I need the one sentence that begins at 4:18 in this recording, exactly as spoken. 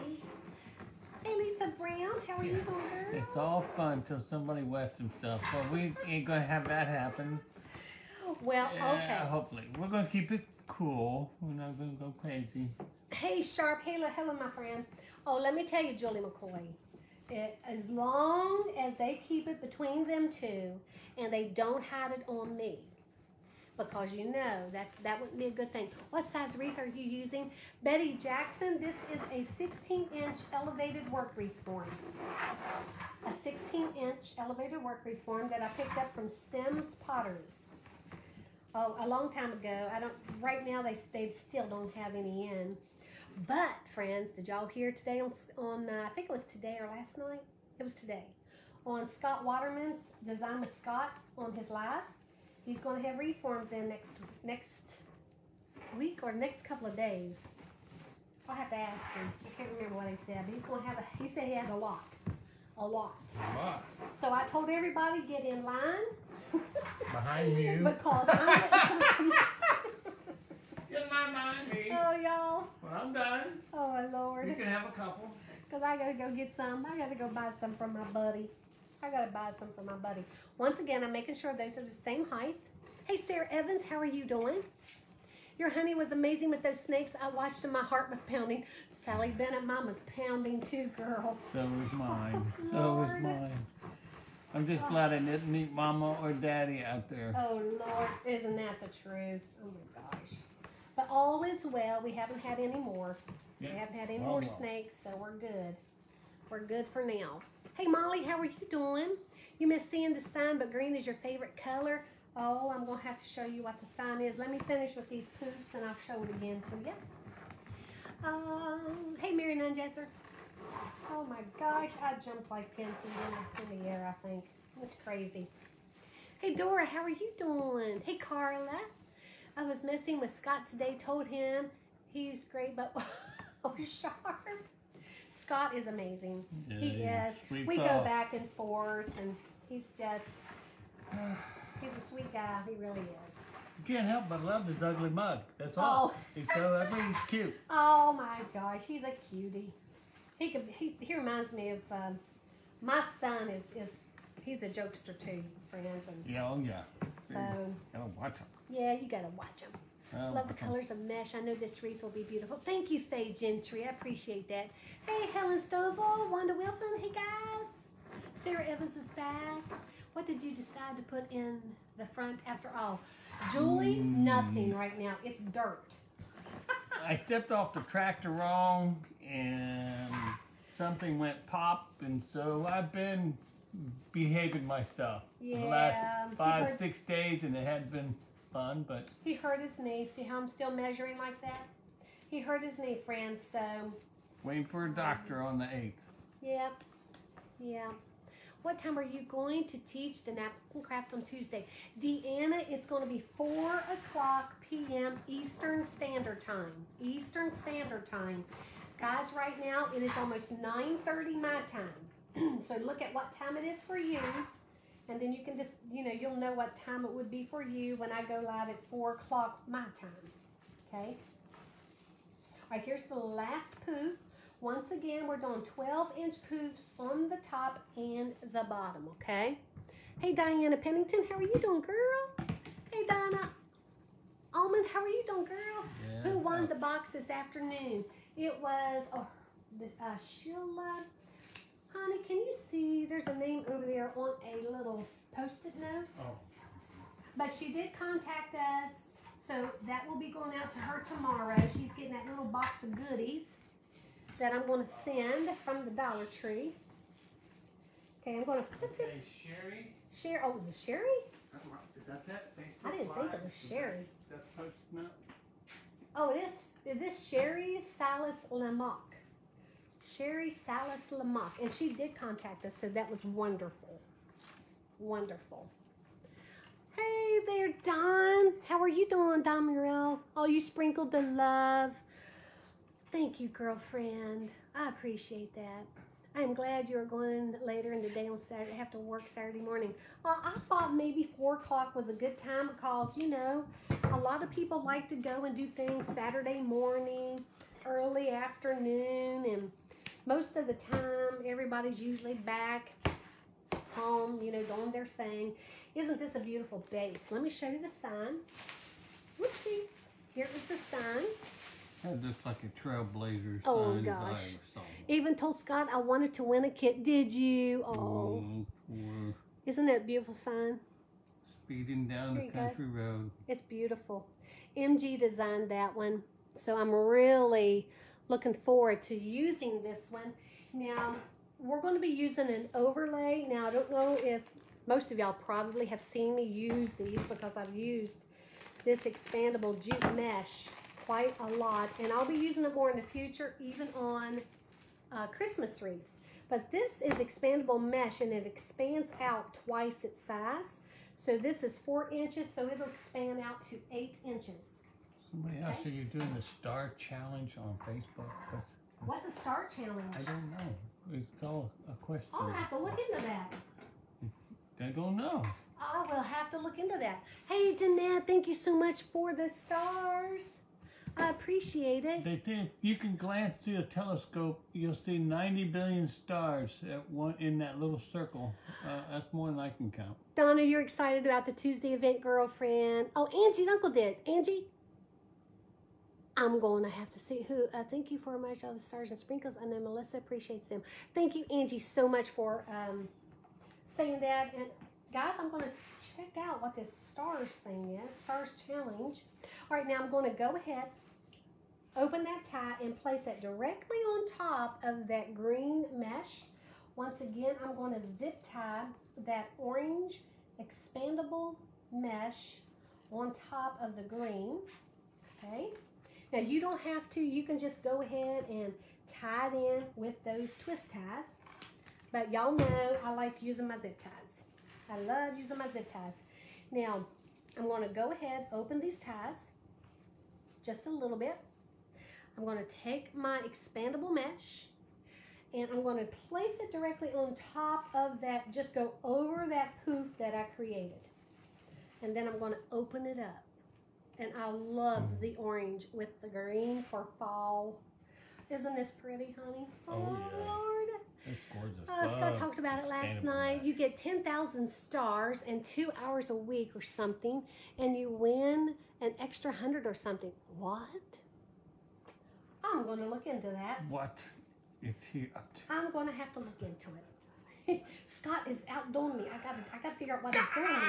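Okay, I'm going to put this.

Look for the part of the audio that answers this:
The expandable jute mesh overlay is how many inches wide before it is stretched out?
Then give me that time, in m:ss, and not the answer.
5:51.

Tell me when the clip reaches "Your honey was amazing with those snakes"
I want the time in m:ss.
1:25.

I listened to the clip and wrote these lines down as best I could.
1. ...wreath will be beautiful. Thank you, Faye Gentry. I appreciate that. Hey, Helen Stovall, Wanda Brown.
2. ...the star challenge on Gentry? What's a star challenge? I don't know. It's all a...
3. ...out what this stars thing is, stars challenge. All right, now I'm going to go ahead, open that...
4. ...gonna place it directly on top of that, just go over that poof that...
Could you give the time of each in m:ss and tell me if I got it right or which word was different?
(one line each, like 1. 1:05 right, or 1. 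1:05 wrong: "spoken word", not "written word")
1. 2:41 wrong: "Wilson", not "Brown"
2. 5:56 wrong: "Facebook", not "Gentry"
3. 6:36 right
4. 7:15 right.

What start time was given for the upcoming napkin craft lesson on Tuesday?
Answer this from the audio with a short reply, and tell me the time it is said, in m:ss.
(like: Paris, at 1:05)
4 o'clock, at 3:23.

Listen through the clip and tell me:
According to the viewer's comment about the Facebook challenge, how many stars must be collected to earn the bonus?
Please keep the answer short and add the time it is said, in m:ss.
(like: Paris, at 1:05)
10,000, at 7:33.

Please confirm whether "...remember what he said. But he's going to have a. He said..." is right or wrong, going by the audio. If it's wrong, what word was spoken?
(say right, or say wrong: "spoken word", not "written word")
right.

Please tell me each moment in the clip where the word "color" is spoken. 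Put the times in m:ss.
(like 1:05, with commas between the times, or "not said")
1:51, 2:40.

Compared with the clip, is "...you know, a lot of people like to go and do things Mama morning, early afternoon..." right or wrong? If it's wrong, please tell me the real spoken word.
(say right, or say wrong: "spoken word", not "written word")
wrong: "Saturday", not "Mama".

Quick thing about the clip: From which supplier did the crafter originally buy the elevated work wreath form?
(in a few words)
Sims Pottery.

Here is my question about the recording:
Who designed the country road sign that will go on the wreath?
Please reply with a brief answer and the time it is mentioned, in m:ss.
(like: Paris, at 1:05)
MG, at 5:24.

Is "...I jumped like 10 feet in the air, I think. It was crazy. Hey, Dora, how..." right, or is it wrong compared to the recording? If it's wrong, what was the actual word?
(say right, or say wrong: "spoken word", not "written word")
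right.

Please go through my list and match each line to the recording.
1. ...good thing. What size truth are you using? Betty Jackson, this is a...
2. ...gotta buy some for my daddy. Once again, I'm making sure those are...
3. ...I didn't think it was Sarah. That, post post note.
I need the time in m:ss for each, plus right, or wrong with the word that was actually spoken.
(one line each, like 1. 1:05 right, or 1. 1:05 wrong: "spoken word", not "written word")
1. 0:25 wrong: "wreath", not "truth"
2. 1:19 wrong: "buddy", not "daddy"
3. 4:22 wrong: "Sherry", not "Sarah".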